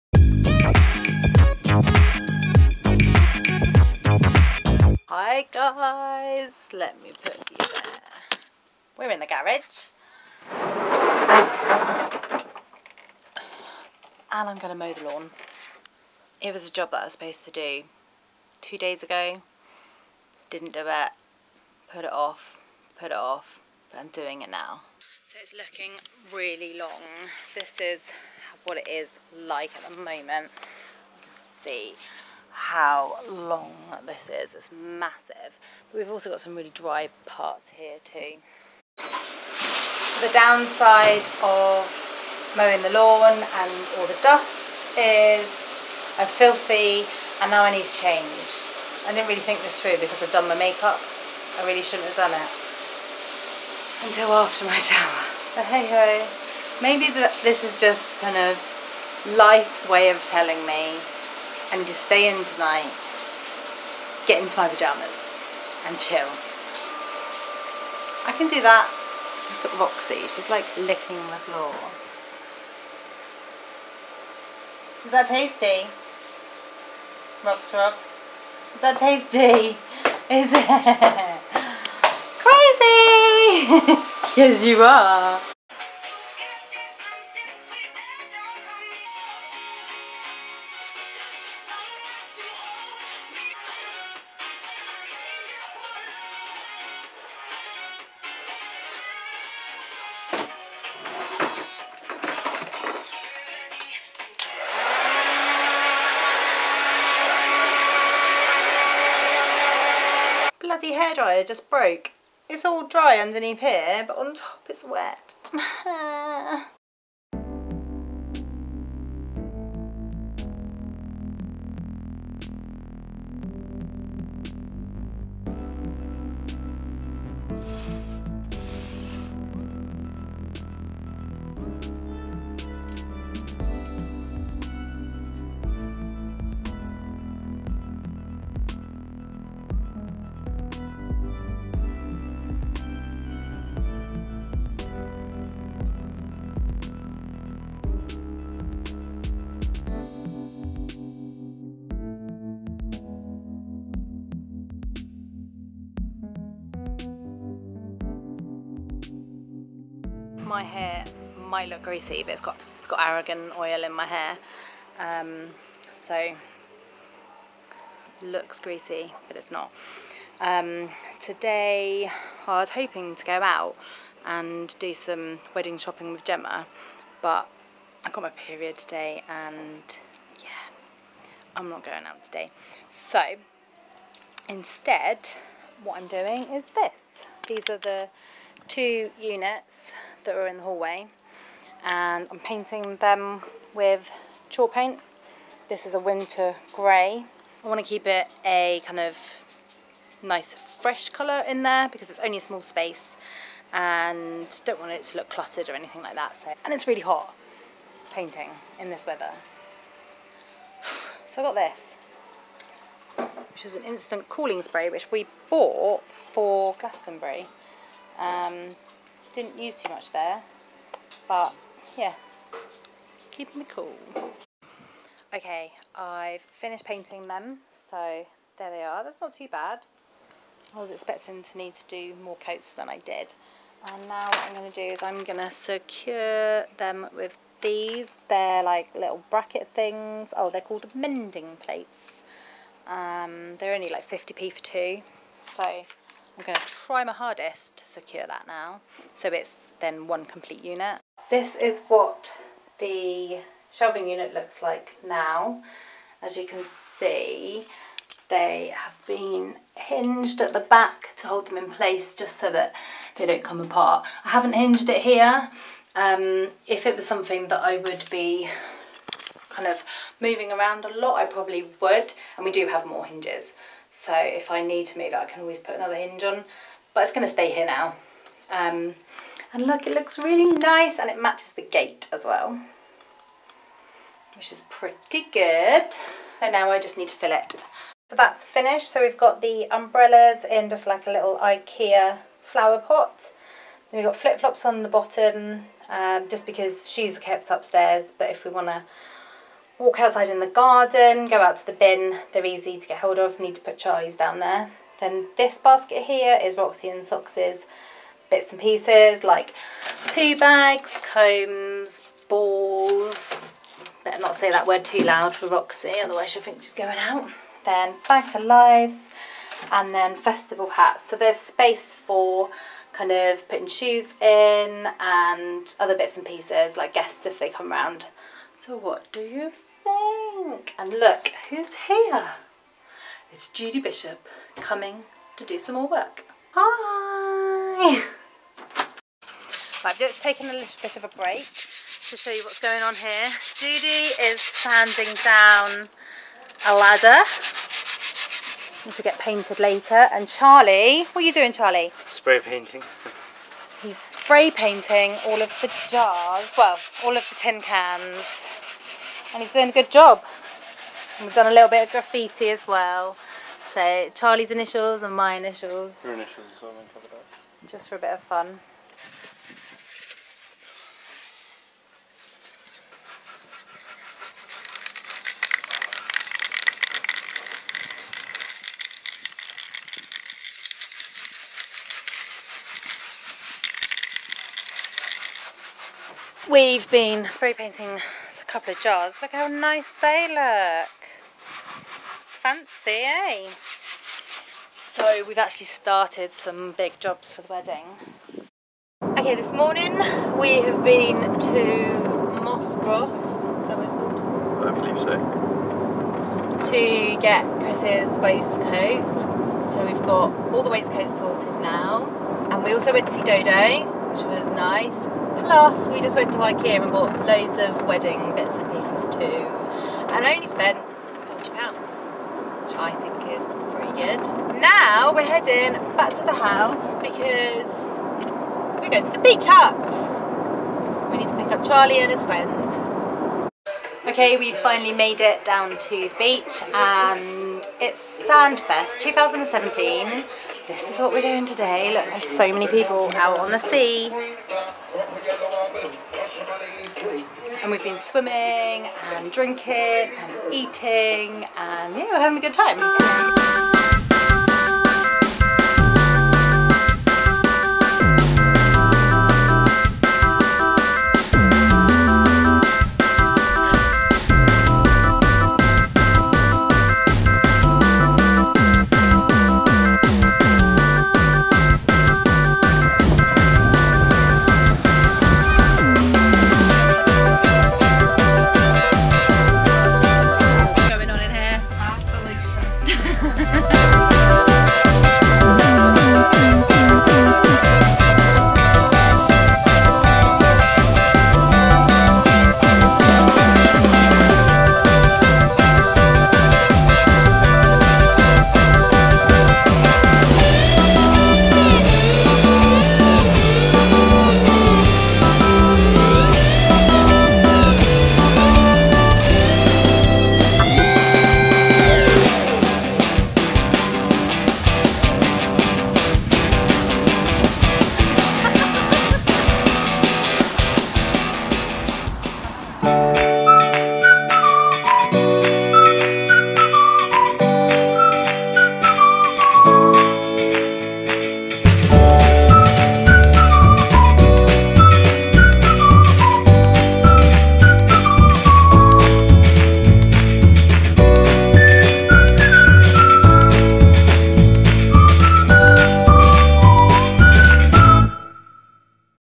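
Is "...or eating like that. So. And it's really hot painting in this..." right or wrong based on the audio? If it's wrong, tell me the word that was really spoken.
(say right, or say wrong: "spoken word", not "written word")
wrong: "anything", not "eating".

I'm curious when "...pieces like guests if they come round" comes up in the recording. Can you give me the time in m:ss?
5:26.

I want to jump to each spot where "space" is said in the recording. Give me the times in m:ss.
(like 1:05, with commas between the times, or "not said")
3:22, 5:21.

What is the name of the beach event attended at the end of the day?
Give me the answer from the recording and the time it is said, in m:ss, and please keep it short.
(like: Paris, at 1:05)
Sandfest 2017, at 7:18.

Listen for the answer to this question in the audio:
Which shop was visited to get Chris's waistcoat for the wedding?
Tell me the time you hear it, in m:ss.
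6:42.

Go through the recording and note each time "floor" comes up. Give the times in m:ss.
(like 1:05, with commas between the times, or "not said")
1:11.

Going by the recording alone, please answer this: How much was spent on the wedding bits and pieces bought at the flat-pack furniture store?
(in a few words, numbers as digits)
£40.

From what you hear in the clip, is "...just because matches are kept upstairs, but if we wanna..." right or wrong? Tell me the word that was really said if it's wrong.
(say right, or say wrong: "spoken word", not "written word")
wrong: "shoes", not "matches".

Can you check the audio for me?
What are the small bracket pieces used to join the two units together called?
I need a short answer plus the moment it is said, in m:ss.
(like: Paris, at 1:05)
Mending plates, at 4:00.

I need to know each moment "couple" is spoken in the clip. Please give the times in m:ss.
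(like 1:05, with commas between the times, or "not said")
6:28.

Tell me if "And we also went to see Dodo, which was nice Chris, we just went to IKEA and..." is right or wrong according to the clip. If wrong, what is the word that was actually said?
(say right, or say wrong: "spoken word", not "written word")
wrong: "Plus", not "Chris".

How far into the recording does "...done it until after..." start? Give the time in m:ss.
0:52.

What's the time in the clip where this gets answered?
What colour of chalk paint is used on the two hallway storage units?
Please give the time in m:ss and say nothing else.
3:15.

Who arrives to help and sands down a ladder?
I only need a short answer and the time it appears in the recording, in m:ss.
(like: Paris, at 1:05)
Judy Bishop, at 5:33.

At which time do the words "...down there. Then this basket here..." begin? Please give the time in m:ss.
5:04.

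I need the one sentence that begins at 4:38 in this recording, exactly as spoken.
Um, and look, it looks really nice and it matches the gate as well, which is pretty good.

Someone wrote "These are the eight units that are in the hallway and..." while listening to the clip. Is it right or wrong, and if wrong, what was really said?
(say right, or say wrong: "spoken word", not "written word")
wrong: "two", not "eight".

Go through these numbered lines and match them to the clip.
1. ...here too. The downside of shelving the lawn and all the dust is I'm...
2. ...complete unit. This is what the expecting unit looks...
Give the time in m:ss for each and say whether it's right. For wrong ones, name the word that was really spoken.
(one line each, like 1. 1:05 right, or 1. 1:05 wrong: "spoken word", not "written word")
1. 0:37 wrong: "mowing", not "shelving"
2. 4:10 wrong: "shelving", not "expecting".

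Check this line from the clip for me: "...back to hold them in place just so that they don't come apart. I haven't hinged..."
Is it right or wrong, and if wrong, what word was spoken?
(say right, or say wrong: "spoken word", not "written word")
right.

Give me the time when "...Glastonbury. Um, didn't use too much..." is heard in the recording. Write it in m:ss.
3:36.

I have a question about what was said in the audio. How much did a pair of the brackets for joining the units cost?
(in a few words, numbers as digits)
50p.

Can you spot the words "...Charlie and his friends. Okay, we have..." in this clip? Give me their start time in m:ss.
7:11.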